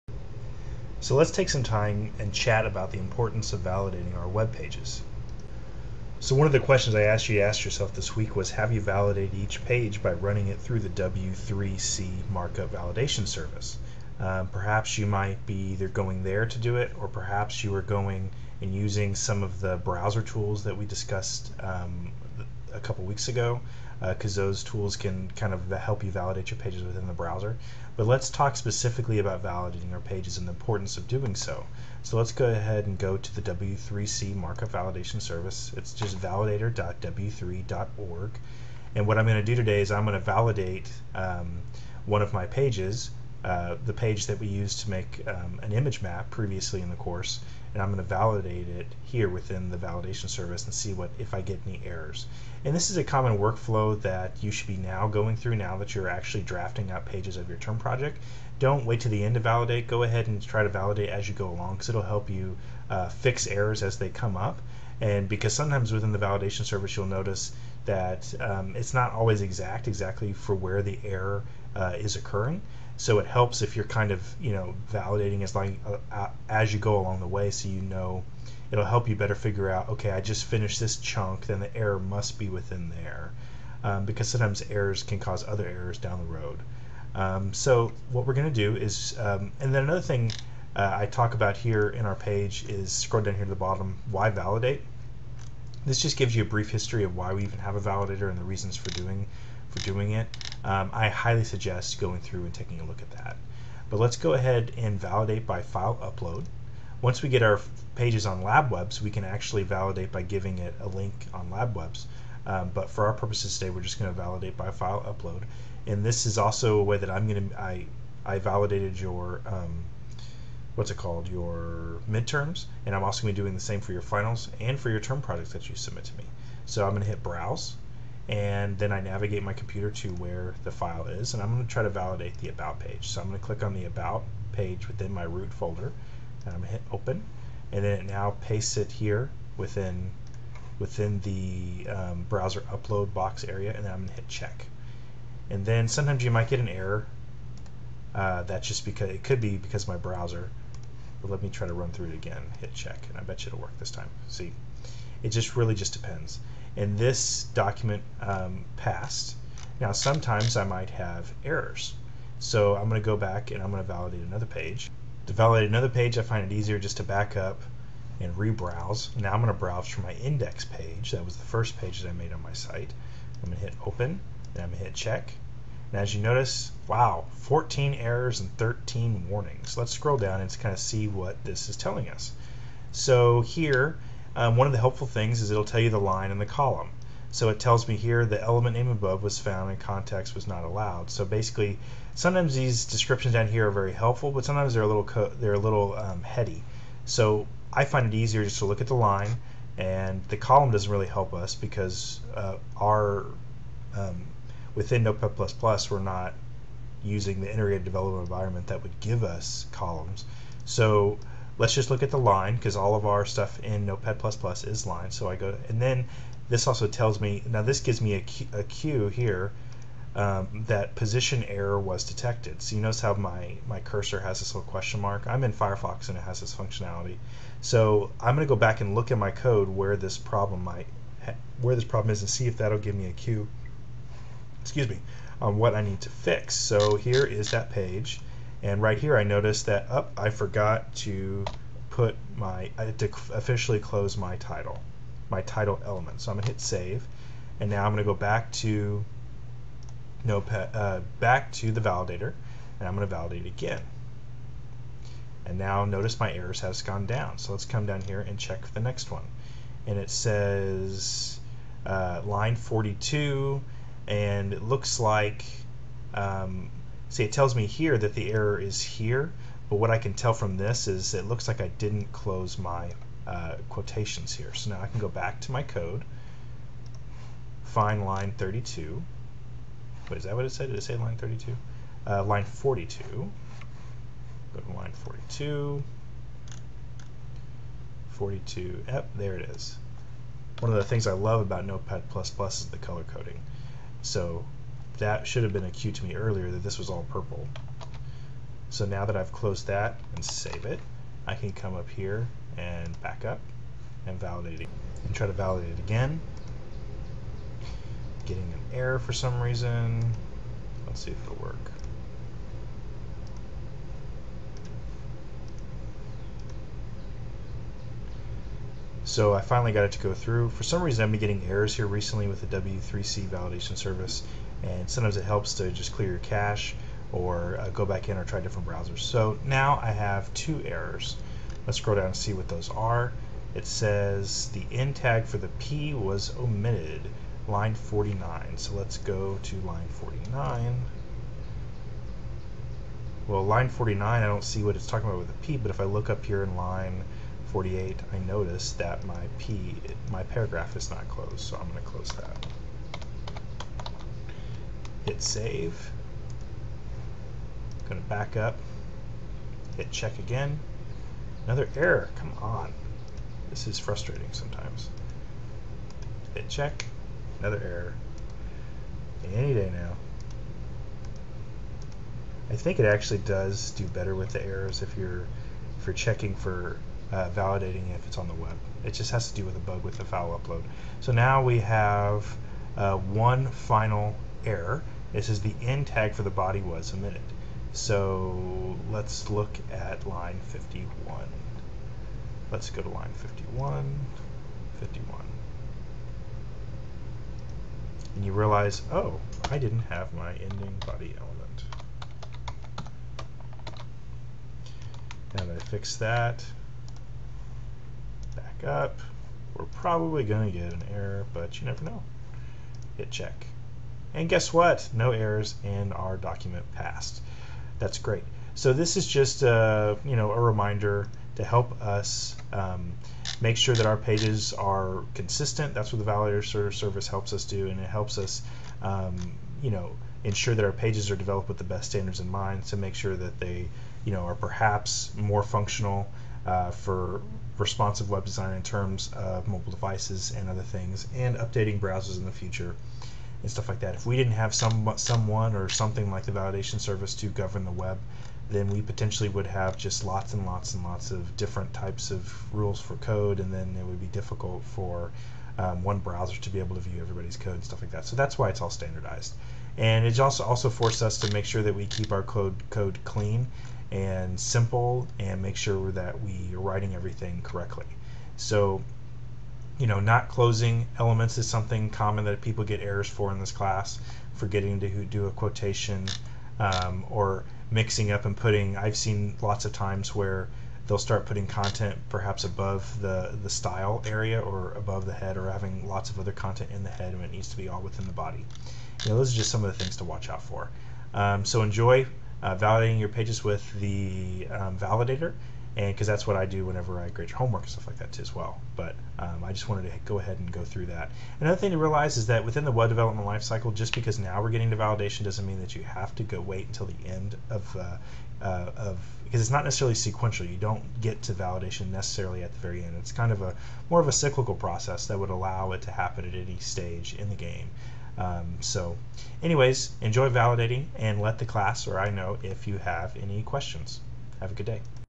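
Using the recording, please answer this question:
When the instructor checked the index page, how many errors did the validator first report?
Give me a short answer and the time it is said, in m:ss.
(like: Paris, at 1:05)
14, at 2:57.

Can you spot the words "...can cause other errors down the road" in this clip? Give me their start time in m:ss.
1:25.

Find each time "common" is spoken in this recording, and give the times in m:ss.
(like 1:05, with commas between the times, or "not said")
0:53, 7:51.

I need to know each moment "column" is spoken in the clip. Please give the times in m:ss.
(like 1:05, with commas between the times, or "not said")
3:06, 3:20, 3:29.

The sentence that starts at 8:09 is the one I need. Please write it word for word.
You know, those are just some of the things to watch out for.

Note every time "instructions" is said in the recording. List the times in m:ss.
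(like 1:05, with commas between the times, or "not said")
not said.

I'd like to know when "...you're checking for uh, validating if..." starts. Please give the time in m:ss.
6:15.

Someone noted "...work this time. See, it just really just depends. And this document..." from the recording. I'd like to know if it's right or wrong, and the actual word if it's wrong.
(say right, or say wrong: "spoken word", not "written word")
right.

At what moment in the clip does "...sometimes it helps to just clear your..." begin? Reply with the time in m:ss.
5:24.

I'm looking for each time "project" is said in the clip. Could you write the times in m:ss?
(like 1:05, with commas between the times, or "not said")
0:57, 2:05.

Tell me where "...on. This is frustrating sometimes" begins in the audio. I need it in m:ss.
6:02.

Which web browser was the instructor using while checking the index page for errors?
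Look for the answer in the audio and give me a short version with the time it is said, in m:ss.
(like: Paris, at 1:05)
Firefox, at 3:45.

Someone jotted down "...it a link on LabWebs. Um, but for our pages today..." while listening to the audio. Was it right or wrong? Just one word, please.
wrong.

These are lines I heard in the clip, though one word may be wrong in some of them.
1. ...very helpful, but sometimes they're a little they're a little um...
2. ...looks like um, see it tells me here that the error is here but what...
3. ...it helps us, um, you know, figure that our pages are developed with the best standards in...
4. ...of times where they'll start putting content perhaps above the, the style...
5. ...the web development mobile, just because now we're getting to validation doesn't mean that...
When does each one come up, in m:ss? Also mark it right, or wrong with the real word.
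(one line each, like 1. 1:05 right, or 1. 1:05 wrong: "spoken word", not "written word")
1. 3:13 right
2. 4:24 right
3. 7:07 wrong: "ensure", not "figure"
4. 7:59 right
5. 8:22 wrong: "lifecycle", not "mobile".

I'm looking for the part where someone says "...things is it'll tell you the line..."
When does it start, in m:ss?
3:05.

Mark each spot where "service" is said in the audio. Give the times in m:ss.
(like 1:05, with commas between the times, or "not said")
0:13, 0:35, 0:50, 1:06, 5:23, 7:06, 7:26.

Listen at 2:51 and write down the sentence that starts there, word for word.
That was the first page that I made on my site.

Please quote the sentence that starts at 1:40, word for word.
Um, I highly suggest going through and taking a look at that.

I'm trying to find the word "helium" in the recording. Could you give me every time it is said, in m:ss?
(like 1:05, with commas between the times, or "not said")
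not said.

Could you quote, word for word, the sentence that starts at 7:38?
So that's why it's all standardized.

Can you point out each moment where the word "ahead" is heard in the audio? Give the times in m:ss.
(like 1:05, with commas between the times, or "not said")
0:32, 1:00, 1:44, 8:20.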